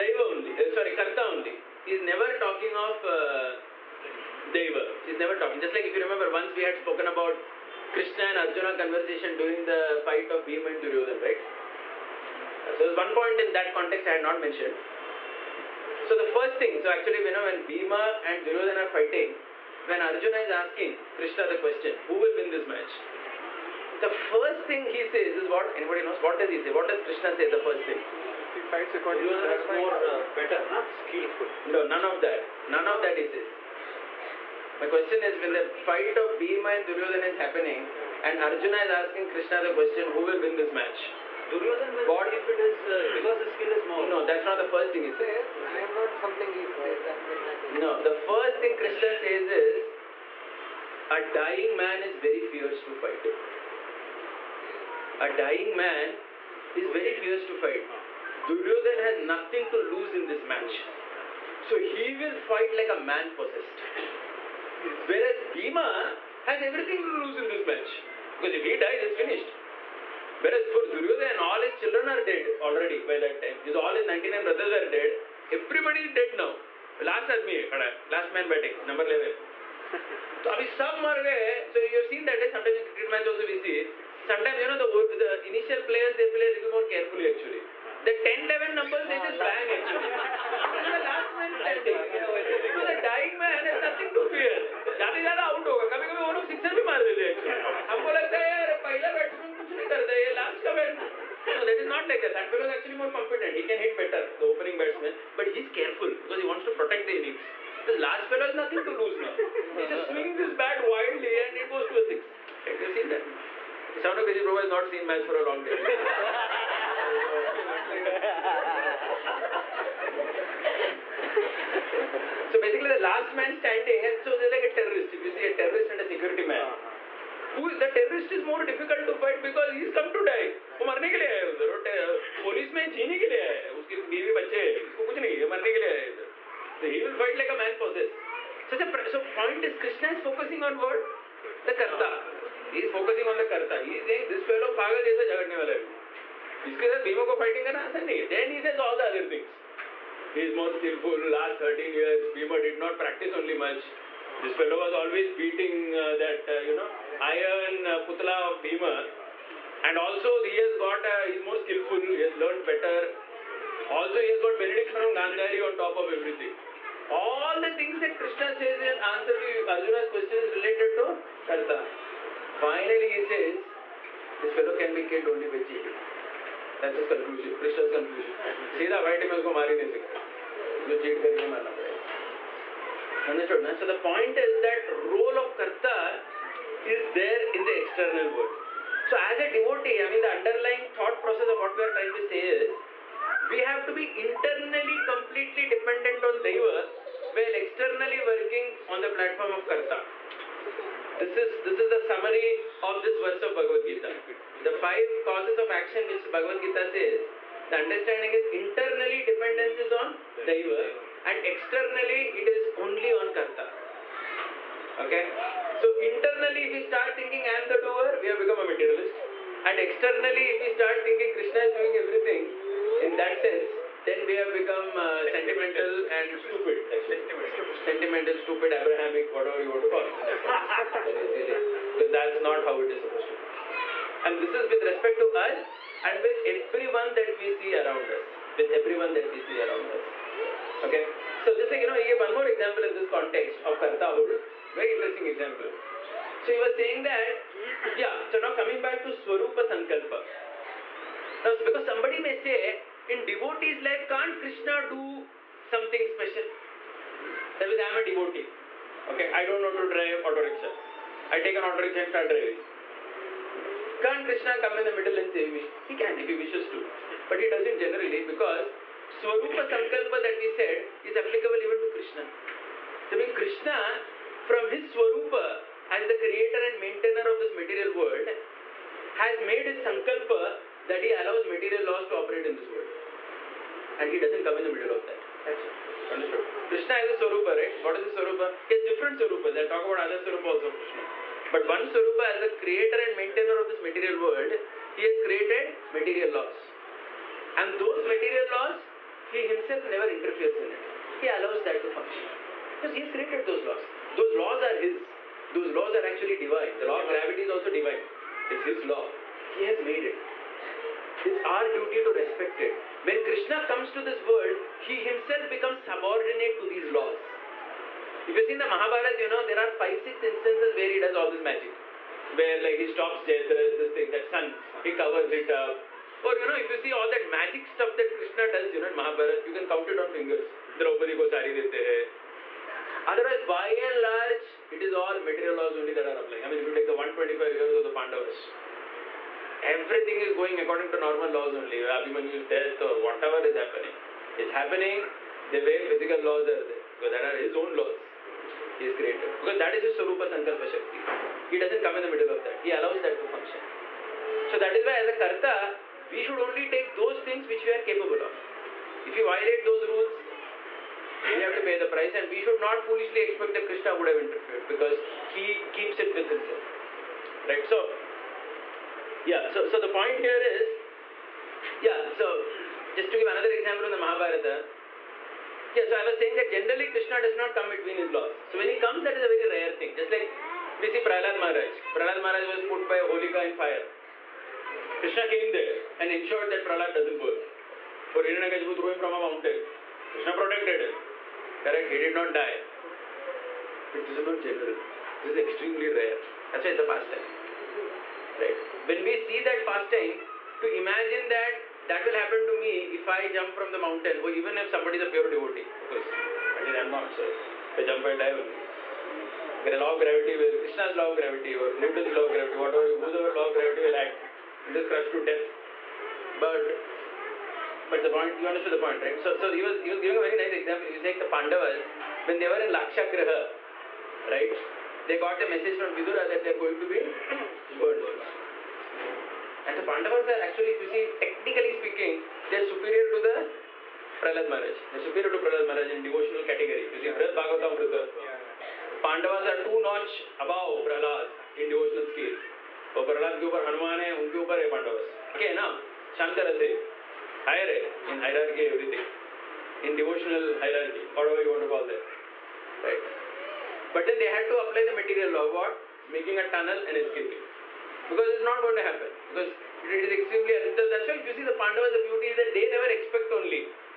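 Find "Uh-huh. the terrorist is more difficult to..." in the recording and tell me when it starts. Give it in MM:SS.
02:06.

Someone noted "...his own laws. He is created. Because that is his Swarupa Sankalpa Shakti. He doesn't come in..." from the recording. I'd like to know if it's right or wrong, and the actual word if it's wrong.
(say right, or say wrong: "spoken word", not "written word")
right.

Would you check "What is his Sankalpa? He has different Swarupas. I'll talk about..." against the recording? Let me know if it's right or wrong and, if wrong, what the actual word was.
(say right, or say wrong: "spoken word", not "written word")
wrong: "Swarupa", not "Sankalpa".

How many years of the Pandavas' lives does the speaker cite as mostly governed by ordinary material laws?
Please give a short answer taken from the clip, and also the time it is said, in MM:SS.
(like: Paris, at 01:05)
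125, at 05:36.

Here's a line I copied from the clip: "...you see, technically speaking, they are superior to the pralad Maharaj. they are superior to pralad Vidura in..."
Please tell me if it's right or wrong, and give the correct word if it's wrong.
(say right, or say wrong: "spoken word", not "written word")
wrong: "Maharaj", not "Vidura".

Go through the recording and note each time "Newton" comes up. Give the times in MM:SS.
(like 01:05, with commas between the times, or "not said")
06:51.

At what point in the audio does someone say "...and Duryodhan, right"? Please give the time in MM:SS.
00:10.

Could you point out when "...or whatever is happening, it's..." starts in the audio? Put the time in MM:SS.
05:42.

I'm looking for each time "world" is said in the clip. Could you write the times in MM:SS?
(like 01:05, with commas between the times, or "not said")
03:08, 04:37, 04:42, 04:54, 05:14.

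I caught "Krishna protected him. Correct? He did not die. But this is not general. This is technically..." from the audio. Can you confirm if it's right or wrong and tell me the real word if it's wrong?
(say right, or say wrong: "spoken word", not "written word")
wrong: "extremely", not "technically".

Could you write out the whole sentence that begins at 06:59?
So, so he was he was giving a very nice example.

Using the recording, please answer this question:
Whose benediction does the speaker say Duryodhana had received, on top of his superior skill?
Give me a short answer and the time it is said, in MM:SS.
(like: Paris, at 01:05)
Gandhari, at 02:45.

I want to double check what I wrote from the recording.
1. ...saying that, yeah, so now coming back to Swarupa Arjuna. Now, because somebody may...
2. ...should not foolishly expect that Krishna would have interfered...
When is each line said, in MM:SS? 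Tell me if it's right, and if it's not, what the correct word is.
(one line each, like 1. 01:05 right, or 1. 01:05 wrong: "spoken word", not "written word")
1. 04:06 wrong: "Sankalpa", not "Arjuna"
2. 06:02 right.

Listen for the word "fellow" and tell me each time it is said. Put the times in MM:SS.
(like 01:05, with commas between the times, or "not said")
01:42, 01:48, 02:24, 02:34, 02:54.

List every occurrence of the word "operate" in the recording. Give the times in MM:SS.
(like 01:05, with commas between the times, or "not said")
04:42.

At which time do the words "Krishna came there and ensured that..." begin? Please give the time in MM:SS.
06:24.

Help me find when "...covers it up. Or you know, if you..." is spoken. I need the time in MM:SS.
05:24.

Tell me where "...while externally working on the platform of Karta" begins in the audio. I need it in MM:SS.
03:17.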